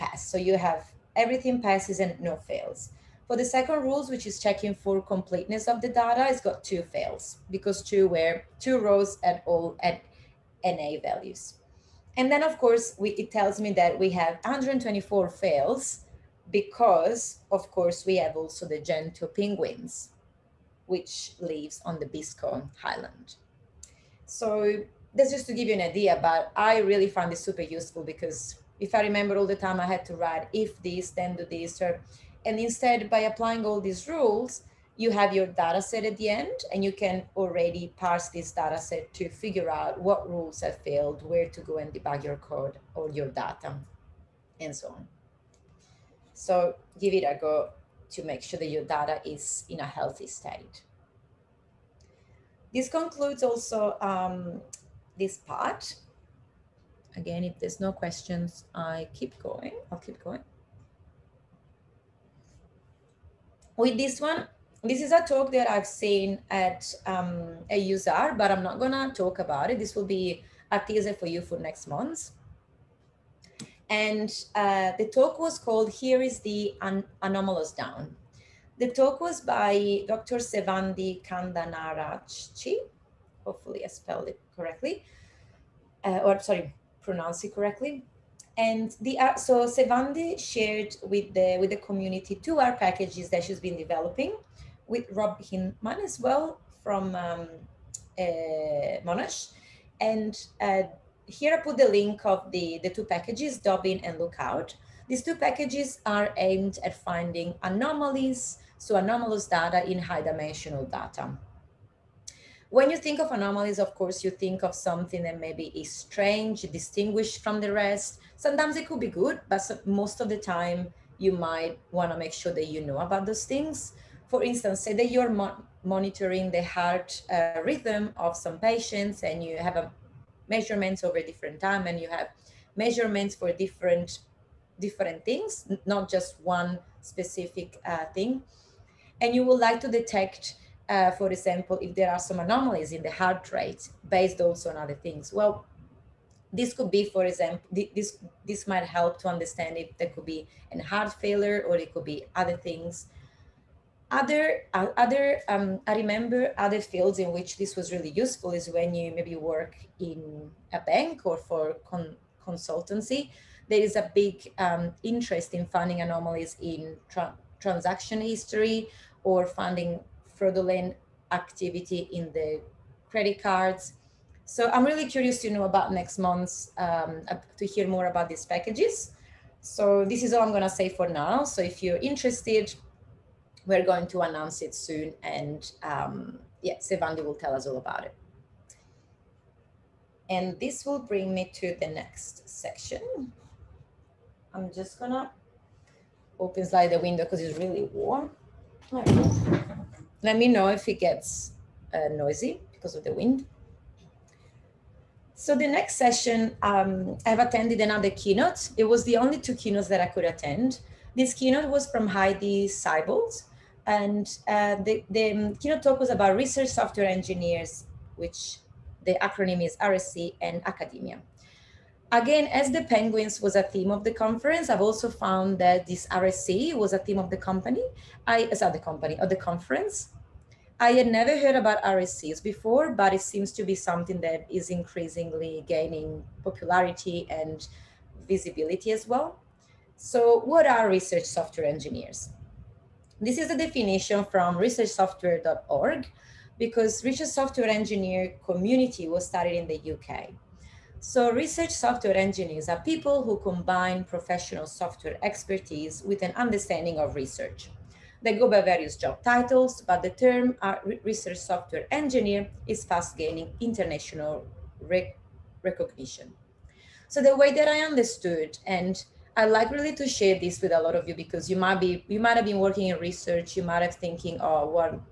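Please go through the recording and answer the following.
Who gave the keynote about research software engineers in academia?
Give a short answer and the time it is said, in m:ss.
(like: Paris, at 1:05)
Heidi Seibold, at 3:32.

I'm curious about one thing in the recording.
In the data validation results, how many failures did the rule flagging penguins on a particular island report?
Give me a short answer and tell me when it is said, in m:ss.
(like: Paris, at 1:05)
124, at 0:14.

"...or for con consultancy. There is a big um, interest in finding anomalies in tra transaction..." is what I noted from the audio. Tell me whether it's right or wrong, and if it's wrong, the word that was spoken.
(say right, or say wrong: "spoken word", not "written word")
right.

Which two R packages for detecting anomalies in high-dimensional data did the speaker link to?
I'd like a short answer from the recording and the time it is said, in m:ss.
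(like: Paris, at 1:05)
dobin and Lookout, at 1:43.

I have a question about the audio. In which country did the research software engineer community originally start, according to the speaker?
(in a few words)
UK.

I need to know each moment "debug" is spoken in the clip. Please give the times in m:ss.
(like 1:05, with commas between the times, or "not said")
0:41.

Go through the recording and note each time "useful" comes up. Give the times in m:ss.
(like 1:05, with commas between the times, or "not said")
0:27, 2:38.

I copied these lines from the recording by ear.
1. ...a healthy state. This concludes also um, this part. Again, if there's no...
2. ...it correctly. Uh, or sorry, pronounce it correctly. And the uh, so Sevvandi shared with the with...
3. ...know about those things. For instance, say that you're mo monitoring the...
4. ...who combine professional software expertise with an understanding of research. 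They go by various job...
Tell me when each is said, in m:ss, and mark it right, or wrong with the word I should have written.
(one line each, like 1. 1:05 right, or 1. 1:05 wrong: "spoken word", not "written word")
1. 0:49 right
2. 1:24 right
3. 2:02 right
4. 4:13 right.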